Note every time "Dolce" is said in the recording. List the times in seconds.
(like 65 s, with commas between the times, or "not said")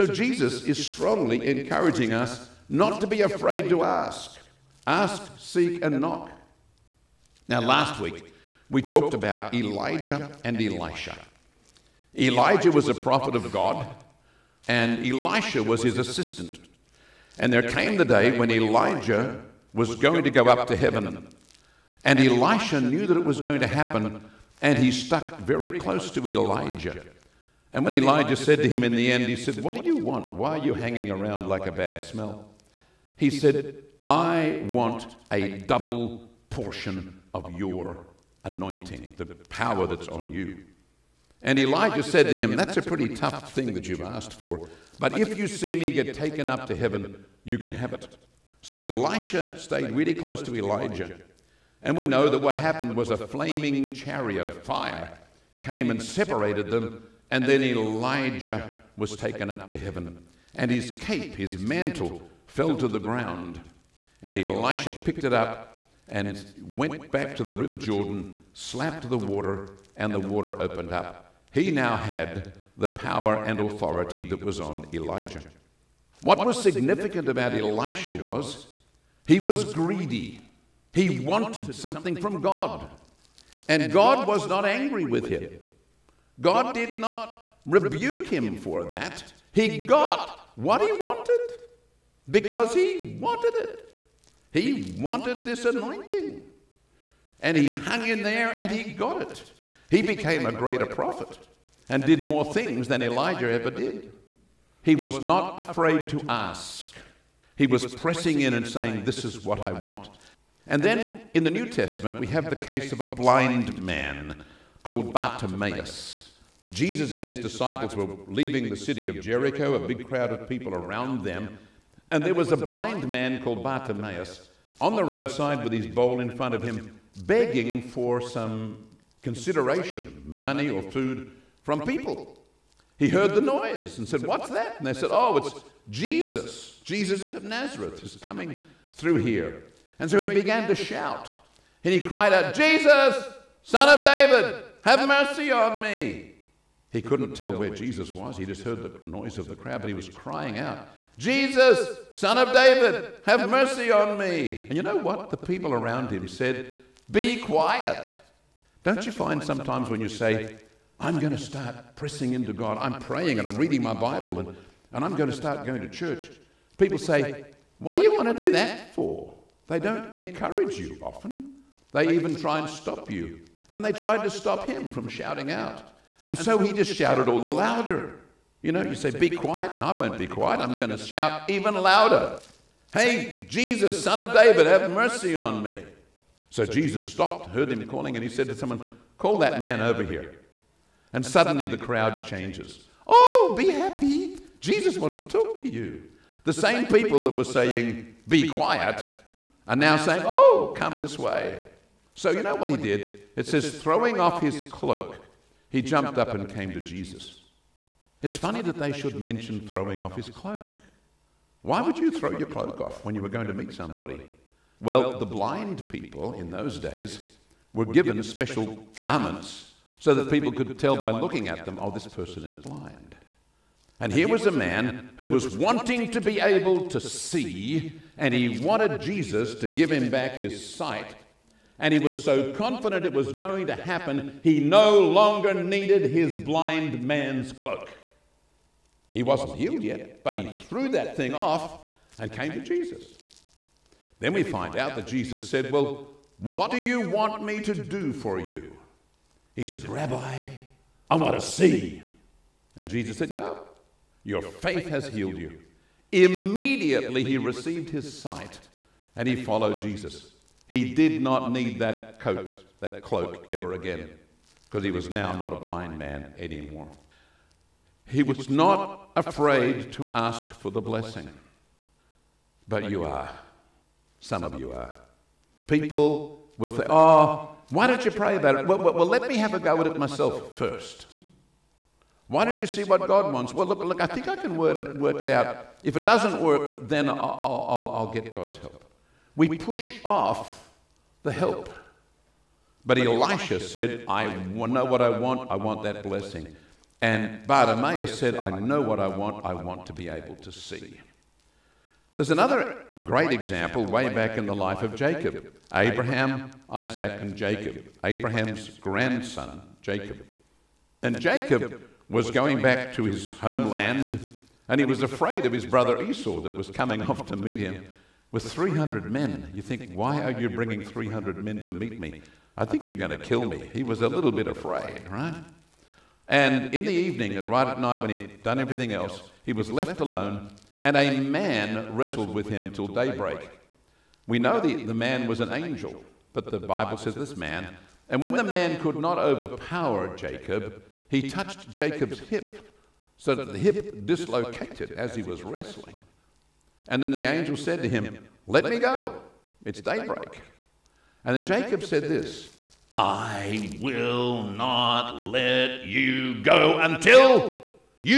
not said.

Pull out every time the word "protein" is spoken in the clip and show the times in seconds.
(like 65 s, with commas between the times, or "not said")
not said.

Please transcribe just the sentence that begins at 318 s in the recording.
With 300 men, you think, why are you bringing 300 men to meet me?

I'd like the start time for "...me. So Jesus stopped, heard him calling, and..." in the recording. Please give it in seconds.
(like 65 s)
185 s.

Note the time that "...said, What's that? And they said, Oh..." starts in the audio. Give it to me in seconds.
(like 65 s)
134 s.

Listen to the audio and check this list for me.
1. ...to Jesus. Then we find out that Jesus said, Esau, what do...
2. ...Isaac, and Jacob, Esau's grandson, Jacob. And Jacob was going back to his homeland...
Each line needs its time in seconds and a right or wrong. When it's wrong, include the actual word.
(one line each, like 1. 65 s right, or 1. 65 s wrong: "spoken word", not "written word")
1. 242 s wrong: "Well", not "Esau"
2. 306 s wrong: "Abraham", not "Esau".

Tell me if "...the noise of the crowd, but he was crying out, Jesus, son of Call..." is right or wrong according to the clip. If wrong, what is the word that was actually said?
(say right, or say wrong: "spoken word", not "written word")
wrong: "David", not "Call".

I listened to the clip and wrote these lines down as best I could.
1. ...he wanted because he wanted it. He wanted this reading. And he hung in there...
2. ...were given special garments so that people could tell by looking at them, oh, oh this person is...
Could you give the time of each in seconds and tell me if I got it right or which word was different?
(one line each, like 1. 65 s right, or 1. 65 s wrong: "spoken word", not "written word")
1. 90 s wrong: "anointing", not "reading"
2. 217 s right.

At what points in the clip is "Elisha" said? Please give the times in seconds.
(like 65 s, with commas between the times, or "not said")
10 s, 15 s, 22 s, 48 s, 64 s, 77 s, 292 s.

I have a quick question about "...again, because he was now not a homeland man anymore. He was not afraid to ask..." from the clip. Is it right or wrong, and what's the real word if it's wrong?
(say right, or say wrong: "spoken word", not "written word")
wrong: "blind", not "homeland".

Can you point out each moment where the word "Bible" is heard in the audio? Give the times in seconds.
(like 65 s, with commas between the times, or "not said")
163 s, 336 s.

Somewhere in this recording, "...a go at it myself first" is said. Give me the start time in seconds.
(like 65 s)
279 s.